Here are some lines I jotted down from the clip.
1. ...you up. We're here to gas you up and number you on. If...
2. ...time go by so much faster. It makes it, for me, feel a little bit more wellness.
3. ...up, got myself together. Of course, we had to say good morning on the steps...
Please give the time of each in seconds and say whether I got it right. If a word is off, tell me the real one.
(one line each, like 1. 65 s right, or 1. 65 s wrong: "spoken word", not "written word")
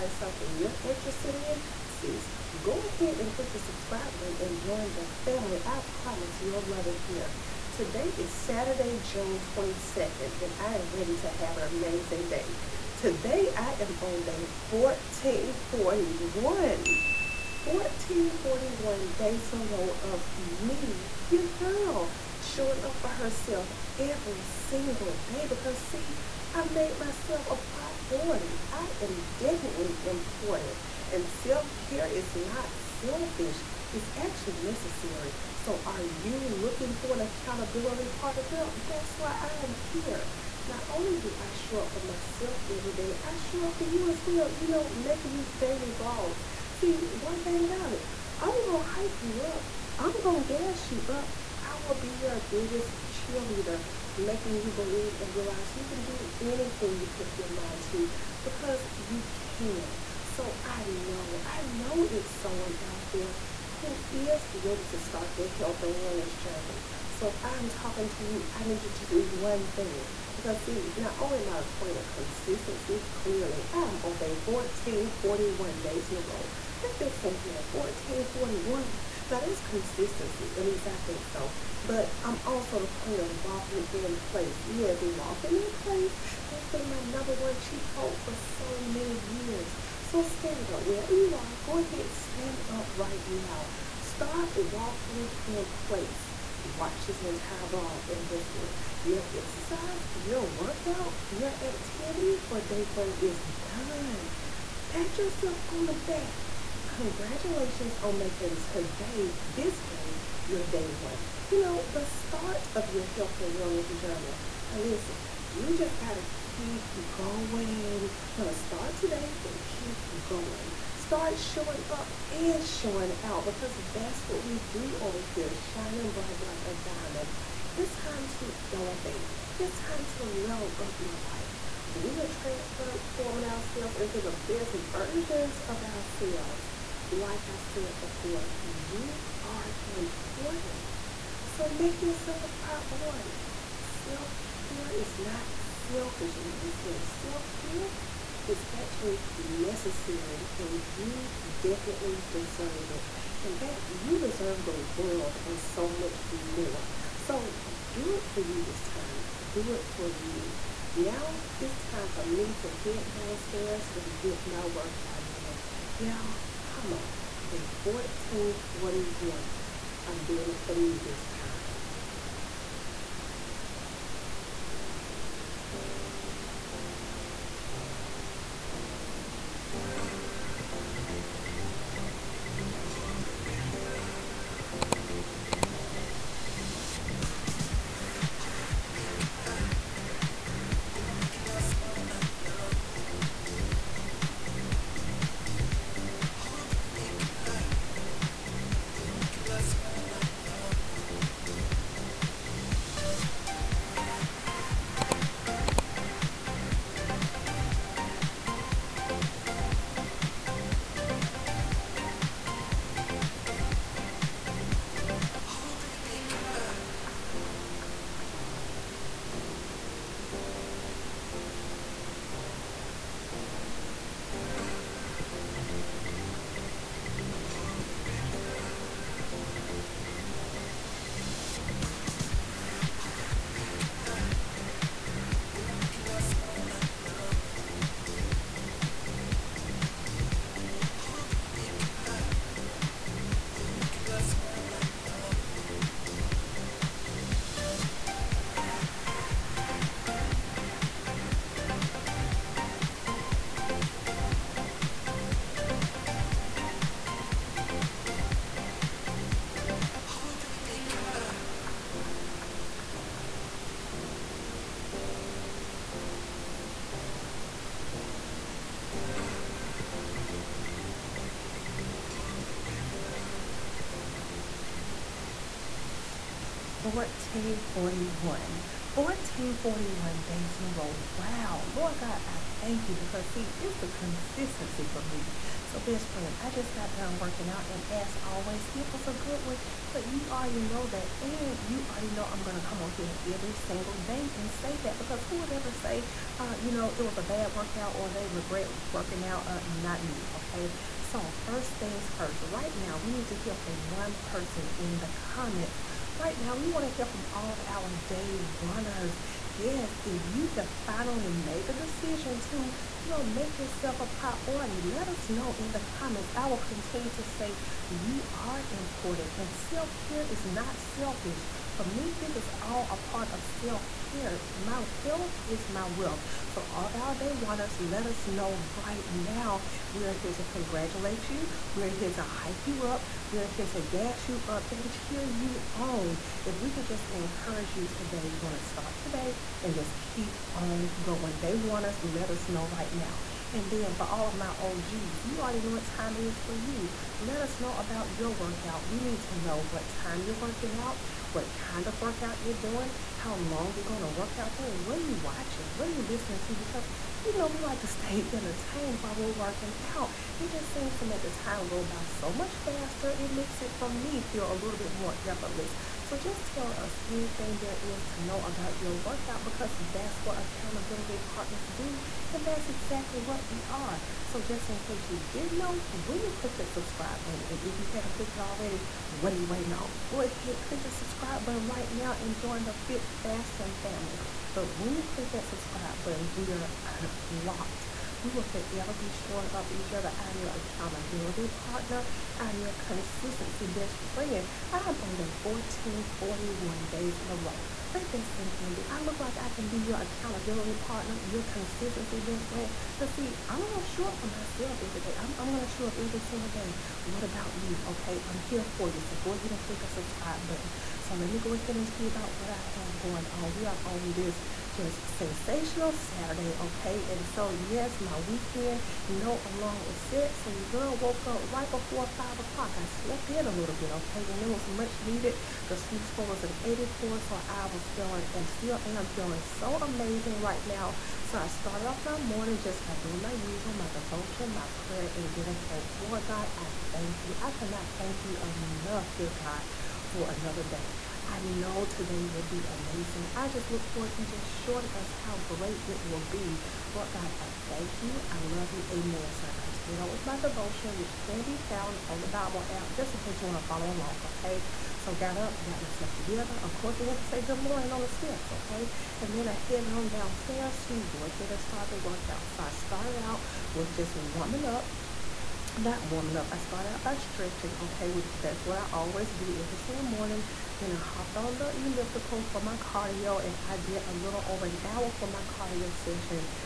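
1. 332 s wrong: "cheer", not "number"
2. 361 s wrong: "effortless", not "wellness"
3. 455 s right.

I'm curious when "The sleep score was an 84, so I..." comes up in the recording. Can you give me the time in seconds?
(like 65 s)
425 s.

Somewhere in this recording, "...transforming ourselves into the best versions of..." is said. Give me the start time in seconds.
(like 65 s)
132 s.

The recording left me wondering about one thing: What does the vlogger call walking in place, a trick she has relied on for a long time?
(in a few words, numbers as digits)
cheat code.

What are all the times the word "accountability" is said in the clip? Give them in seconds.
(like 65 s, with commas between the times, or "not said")
37 s, 370 s, 390 s, 400 s.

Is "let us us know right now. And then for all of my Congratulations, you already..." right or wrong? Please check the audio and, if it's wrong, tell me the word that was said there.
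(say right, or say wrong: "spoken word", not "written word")
wrong: "OGs", not "Congratulations".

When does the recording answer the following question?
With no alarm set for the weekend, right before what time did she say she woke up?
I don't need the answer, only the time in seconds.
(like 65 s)
422 s.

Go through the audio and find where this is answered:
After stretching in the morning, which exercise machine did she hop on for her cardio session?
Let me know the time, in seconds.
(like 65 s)
471 s.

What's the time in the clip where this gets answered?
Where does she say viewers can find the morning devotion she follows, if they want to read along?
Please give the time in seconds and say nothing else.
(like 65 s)
452 s.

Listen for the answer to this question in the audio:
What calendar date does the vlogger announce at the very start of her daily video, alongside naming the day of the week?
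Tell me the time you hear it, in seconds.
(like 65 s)
9 s.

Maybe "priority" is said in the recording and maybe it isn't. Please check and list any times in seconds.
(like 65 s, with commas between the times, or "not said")
27 s, 142 s, 314 s.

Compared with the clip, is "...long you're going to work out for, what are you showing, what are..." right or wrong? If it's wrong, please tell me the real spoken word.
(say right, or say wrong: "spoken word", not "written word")
wrong: "watching", not "showing".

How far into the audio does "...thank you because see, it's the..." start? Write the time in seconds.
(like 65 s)
282 s.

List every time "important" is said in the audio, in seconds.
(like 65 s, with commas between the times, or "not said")
30 s, 139 s, 318 s.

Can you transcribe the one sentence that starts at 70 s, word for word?
Because see, not only am I a queen of consistency, clearly, I'm on day 1441 days in a row.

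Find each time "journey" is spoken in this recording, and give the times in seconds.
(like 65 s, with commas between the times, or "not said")
66 s, 114 s.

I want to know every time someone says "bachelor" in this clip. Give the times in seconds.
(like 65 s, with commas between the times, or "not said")
not said.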